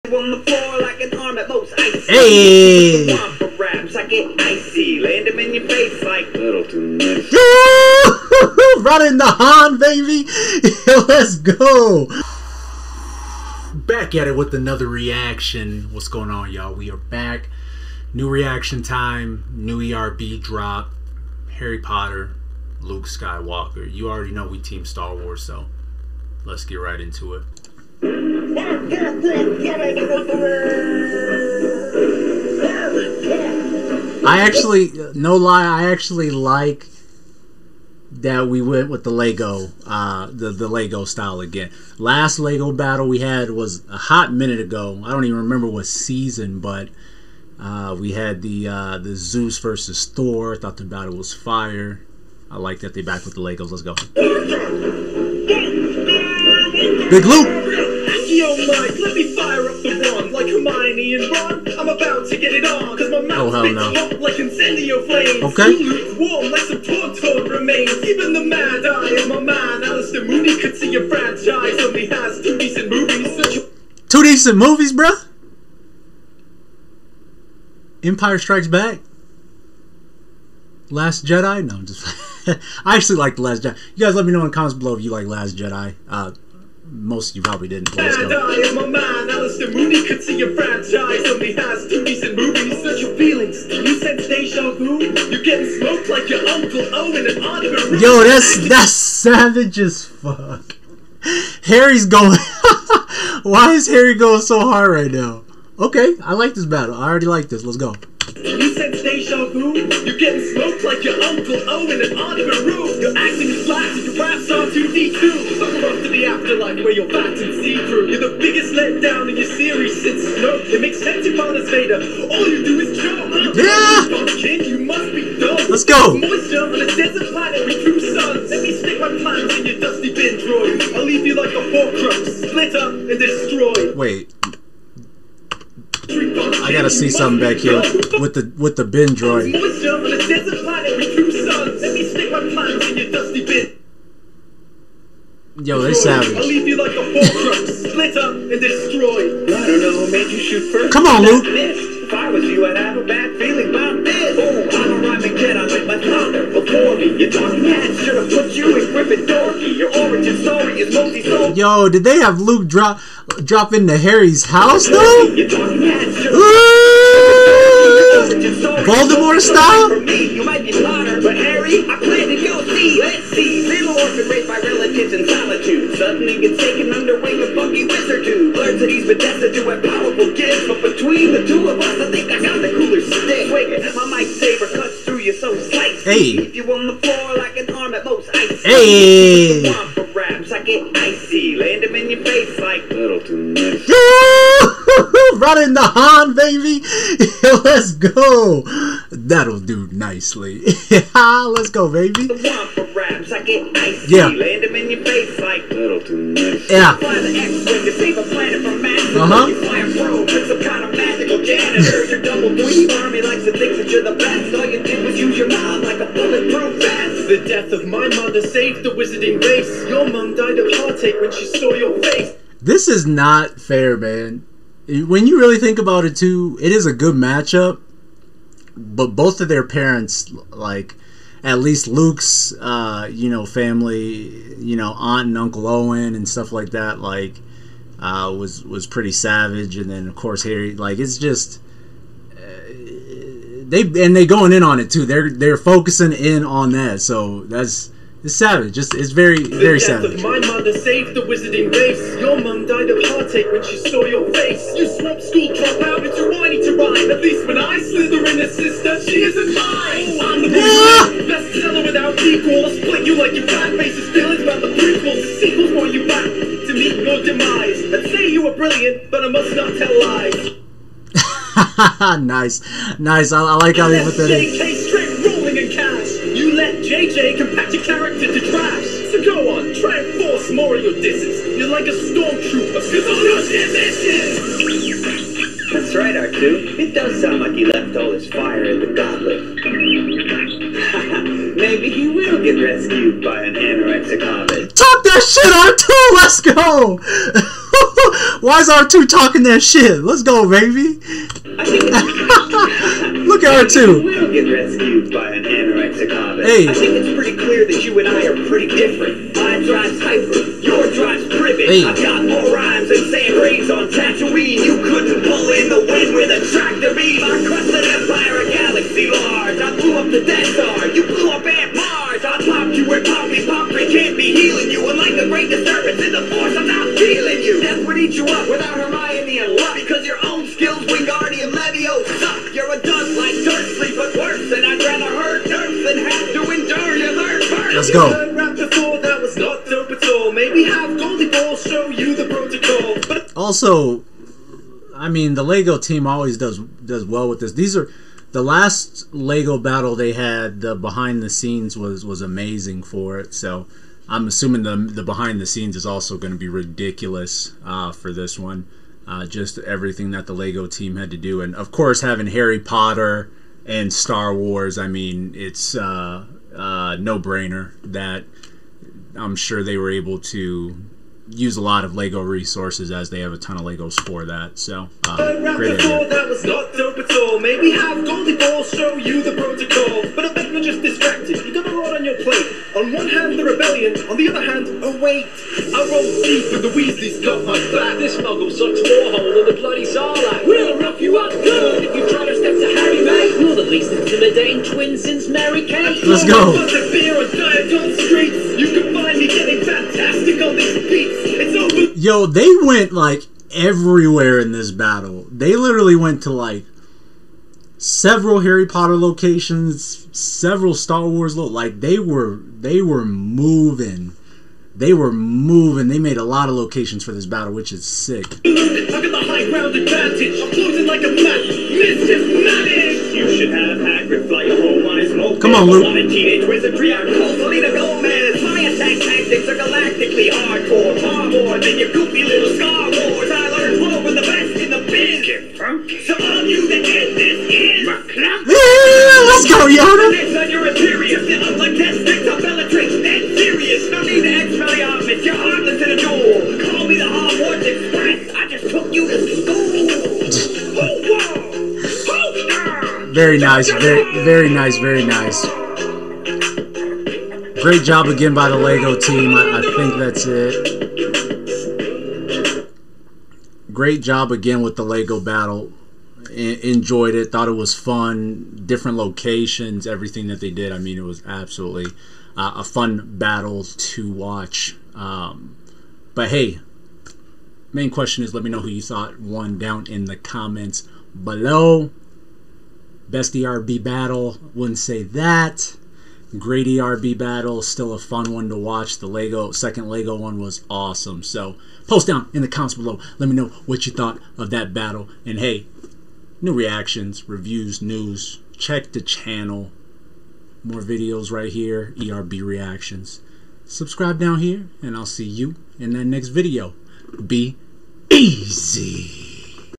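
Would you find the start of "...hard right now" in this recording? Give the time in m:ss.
1:44.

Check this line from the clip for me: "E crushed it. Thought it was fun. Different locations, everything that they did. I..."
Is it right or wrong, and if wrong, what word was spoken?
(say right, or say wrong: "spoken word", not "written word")
wrong: "enjoyed", not "crushed".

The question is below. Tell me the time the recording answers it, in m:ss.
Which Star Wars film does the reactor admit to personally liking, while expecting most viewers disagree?
1:23.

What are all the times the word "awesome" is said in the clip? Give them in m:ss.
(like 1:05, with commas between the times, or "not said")
8:10.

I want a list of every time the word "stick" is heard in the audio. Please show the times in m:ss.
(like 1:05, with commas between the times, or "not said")
2:08, 3:03.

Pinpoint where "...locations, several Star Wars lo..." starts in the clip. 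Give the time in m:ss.
6:48.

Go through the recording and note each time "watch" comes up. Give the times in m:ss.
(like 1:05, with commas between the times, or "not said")
7:54, 8:08.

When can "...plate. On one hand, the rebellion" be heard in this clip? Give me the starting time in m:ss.
6:22.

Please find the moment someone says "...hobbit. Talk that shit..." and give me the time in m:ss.
4:54.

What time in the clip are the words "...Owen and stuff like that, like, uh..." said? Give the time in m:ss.
3:55.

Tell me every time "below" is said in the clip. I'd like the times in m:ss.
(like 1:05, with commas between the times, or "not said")
1:24, 8:01, 8:12.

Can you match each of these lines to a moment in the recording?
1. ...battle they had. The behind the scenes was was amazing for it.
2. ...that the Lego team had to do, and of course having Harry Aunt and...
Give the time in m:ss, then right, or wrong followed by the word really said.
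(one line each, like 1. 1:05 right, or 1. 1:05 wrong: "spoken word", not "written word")
1. 5:49 right
2. 6:00 wrong: "Potter", not "Aunt".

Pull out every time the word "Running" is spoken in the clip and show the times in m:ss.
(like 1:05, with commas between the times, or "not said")
0:08, 3:15.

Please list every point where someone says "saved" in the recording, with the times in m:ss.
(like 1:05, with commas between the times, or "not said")
3:38, 4:10.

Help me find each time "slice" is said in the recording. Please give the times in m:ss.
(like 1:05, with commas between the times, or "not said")
3:05.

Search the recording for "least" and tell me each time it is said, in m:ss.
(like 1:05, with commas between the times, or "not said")
3:51, 6:33.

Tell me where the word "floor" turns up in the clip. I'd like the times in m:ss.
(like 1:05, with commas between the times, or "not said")
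0:00, 3:06.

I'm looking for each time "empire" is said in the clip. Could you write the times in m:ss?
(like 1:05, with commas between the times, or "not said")
1:18, 5:17.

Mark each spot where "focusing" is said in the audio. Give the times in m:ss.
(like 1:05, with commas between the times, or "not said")
4:05.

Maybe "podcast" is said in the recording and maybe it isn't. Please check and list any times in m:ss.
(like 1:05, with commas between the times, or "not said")
not said.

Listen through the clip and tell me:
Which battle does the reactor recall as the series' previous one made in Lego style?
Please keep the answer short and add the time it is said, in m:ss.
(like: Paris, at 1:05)
Zeus versus Thor, at 0:49.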